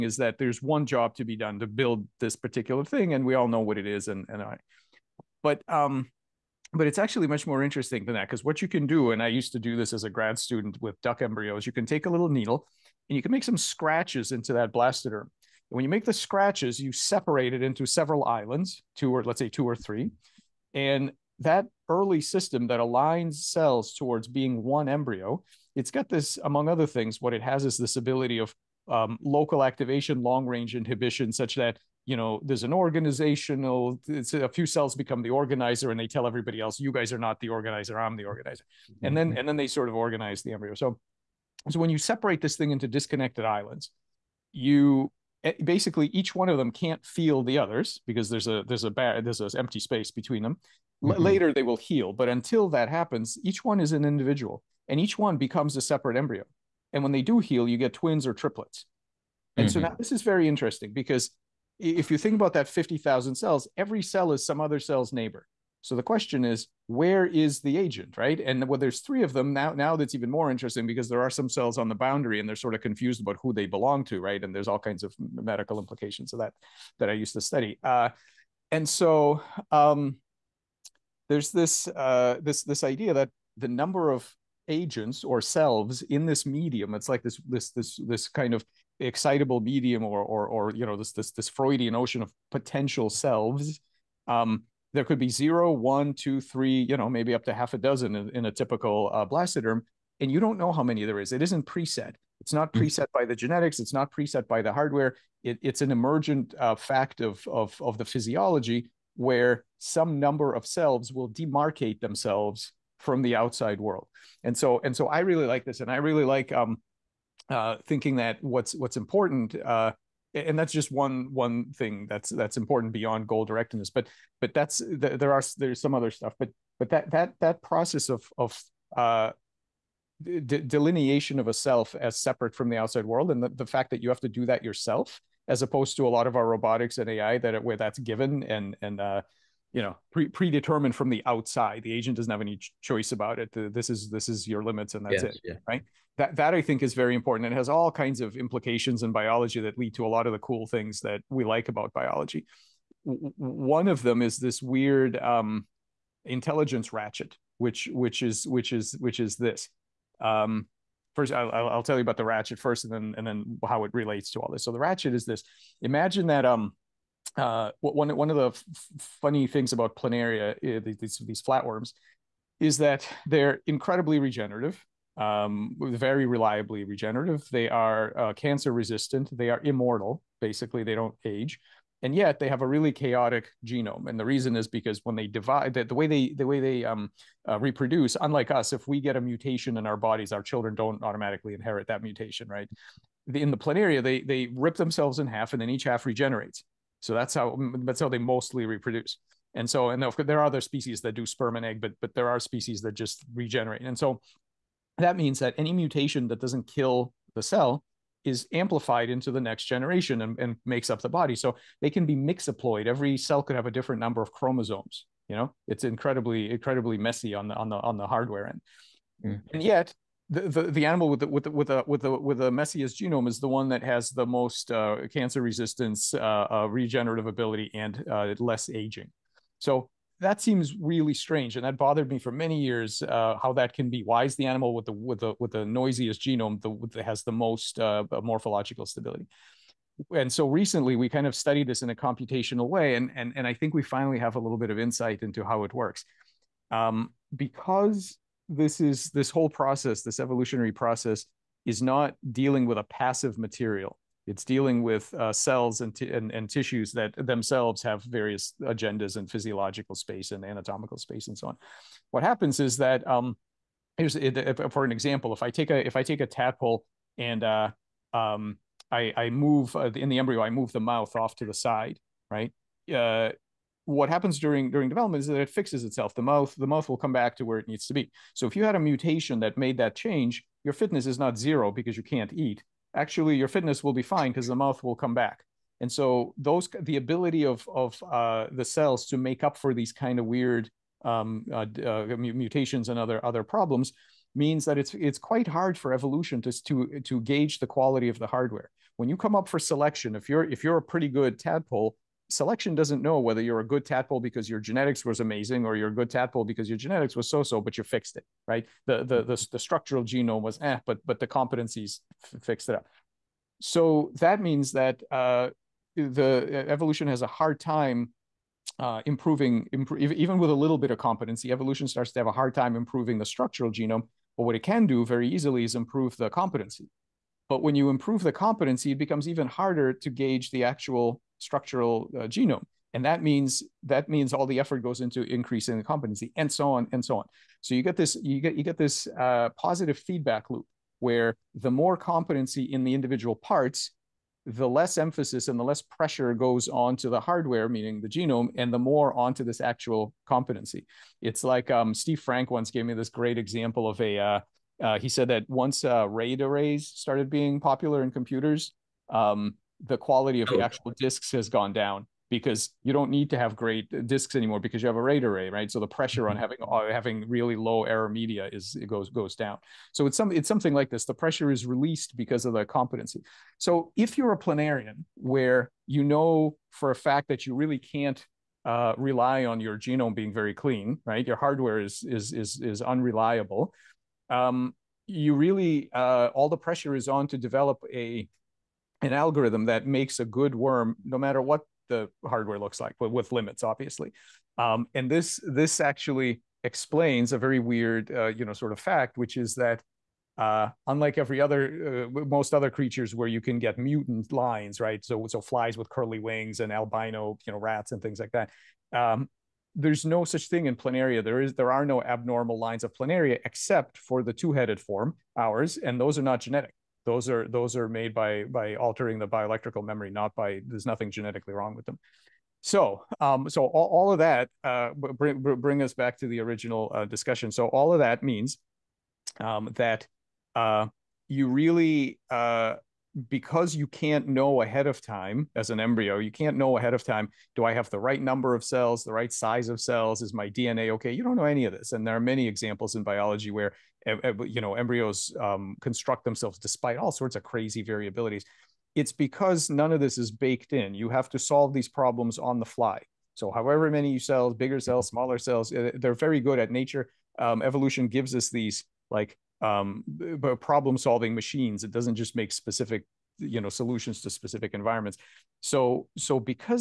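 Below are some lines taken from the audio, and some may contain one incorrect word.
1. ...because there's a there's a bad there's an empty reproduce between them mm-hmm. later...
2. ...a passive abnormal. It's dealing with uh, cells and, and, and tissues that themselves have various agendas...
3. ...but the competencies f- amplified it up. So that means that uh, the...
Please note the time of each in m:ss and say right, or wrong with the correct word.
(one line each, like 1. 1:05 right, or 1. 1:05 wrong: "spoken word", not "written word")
1. 0:48 wrong: "space", not "reproduce"
2. 4:12 wrong: "material", not "abnormal"
3. 5:11 wrong: "fixed", not "amplified".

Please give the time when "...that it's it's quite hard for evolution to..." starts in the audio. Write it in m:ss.
4:54.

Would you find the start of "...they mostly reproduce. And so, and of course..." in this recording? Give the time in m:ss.
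3:18.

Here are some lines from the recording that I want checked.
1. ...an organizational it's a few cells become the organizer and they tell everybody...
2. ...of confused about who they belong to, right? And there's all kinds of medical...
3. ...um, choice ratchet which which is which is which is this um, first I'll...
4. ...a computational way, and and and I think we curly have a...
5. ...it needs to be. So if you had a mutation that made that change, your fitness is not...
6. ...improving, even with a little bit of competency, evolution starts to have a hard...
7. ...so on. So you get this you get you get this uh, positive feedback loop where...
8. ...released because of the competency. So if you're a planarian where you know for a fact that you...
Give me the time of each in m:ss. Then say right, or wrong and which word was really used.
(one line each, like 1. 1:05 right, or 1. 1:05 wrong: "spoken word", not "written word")
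1. 0:32 right
2. 1:12 right
3. 2:35 wrong: "intelligence", not "choice"
4. 4:01 wrong: "finally", not "curly"
5. 4:37 right
6. 5:19 right
7. 5:37 right
8. 6:11 right.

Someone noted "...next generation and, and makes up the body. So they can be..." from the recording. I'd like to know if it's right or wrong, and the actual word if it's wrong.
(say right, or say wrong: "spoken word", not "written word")
right.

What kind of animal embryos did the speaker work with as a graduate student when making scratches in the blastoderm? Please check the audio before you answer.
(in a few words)
Duck embryos.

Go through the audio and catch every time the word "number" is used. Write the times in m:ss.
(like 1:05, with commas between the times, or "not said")
1:23, 1:50, 3:33, 7:18.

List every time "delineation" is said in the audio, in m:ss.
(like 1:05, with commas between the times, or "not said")
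2:10.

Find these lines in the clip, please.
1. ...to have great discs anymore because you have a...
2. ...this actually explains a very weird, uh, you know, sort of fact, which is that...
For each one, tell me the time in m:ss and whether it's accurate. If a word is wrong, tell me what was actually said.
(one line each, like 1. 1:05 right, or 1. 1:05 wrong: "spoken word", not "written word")
1. 6:03 right
2. 6:35 right.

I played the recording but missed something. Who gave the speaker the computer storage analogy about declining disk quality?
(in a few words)
Steve Frank.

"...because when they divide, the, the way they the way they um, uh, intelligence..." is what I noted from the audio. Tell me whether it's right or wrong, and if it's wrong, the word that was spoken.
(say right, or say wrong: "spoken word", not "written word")
wrong: "reproduce", not "intelligence".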